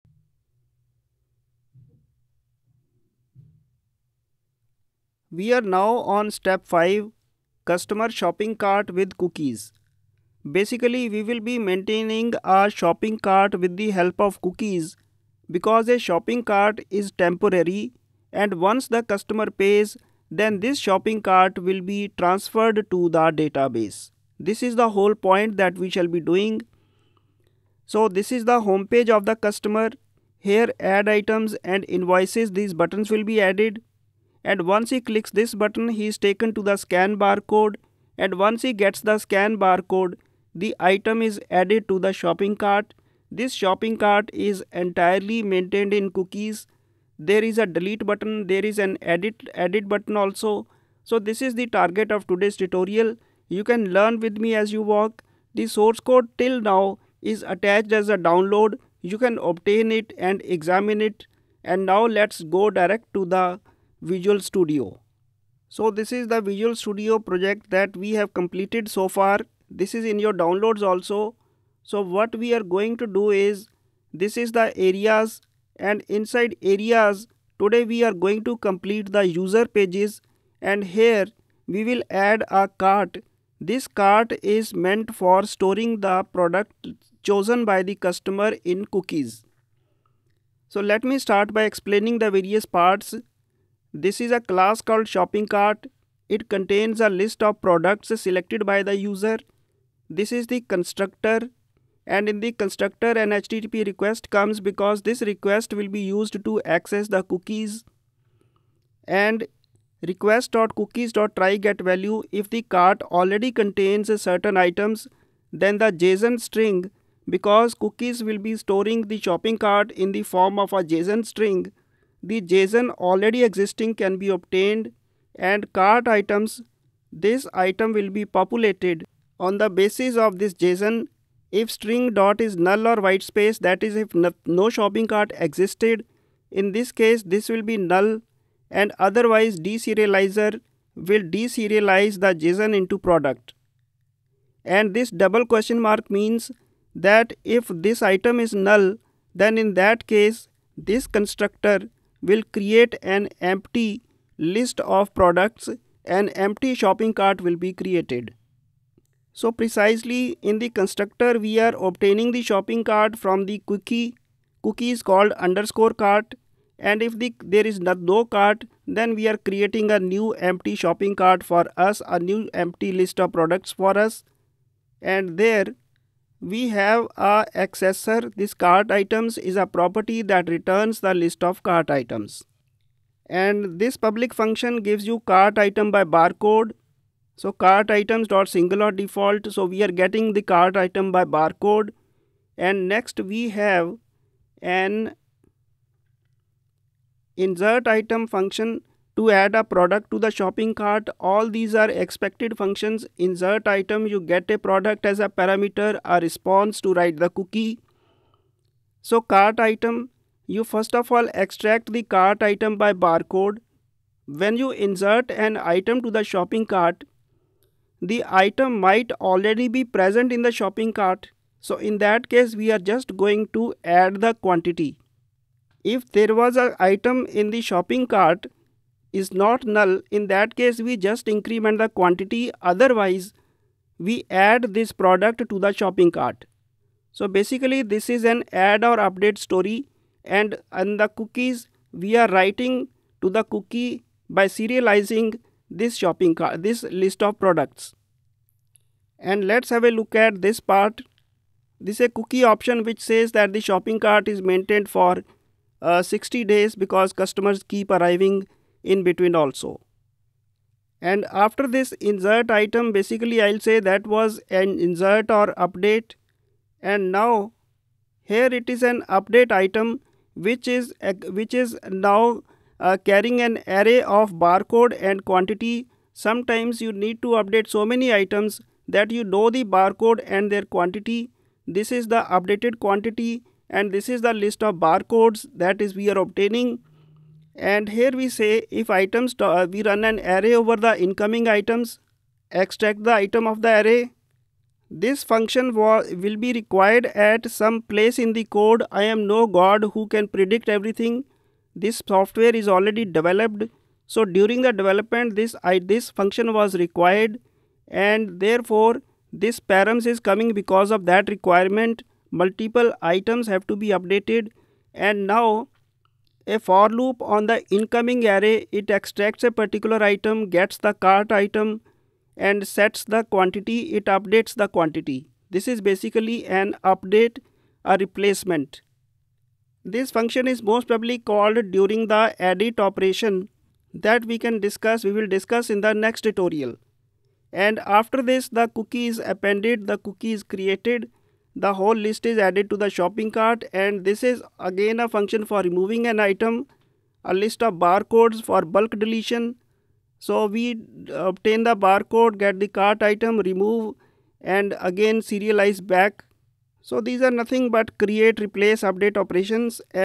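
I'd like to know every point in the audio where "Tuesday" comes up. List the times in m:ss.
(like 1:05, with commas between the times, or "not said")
not said.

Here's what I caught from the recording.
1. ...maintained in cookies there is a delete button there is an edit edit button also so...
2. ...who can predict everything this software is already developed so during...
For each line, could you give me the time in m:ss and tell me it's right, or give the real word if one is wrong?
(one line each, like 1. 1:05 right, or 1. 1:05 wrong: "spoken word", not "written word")
1. 0:45 right
2. 4:59 right.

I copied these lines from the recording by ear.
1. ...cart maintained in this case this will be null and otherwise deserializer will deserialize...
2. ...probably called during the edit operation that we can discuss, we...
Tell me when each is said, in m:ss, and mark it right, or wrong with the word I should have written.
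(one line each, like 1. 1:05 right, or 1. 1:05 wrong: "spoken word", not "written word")
1. 2:15 wrong: "existed", not "maintained"
2. 5:30 right.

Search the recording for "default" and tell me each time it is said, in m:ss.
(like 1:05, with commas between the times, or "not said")
3:08.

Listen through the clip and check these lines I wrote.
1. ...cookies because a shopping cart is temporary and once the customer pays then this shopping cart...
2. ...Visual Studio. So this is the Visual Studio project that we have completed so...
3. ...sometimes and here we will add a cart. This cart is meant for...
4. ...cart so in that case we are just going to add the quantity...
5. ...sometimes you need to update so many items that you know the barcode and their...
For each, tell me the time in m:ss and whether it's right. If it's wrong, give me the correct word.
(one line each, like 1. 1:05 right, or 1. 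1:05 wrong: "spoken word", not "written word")
1. 0:14 right
2. 1:04 right
3. 1:19 wrong: "pages", not "sometimes"
4. 3:40 right
5. 4:36 right.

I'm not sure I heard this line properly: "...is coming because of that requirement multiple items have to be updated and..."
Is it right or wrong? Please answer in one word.
right.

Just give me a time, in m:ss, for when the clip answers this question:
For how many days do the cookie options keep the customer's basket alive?
4:16.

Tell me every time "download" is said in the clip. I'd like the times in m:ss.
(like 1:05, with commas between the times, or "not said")
0:58, 1:10.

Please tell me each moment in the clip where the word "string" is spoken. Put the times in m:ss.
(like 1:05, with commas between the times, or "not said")
1:56, 2:01, 2:11.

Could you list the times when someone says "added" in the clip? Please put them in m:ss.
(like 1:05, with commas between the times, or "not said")
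0:33, 0:41, 5:42.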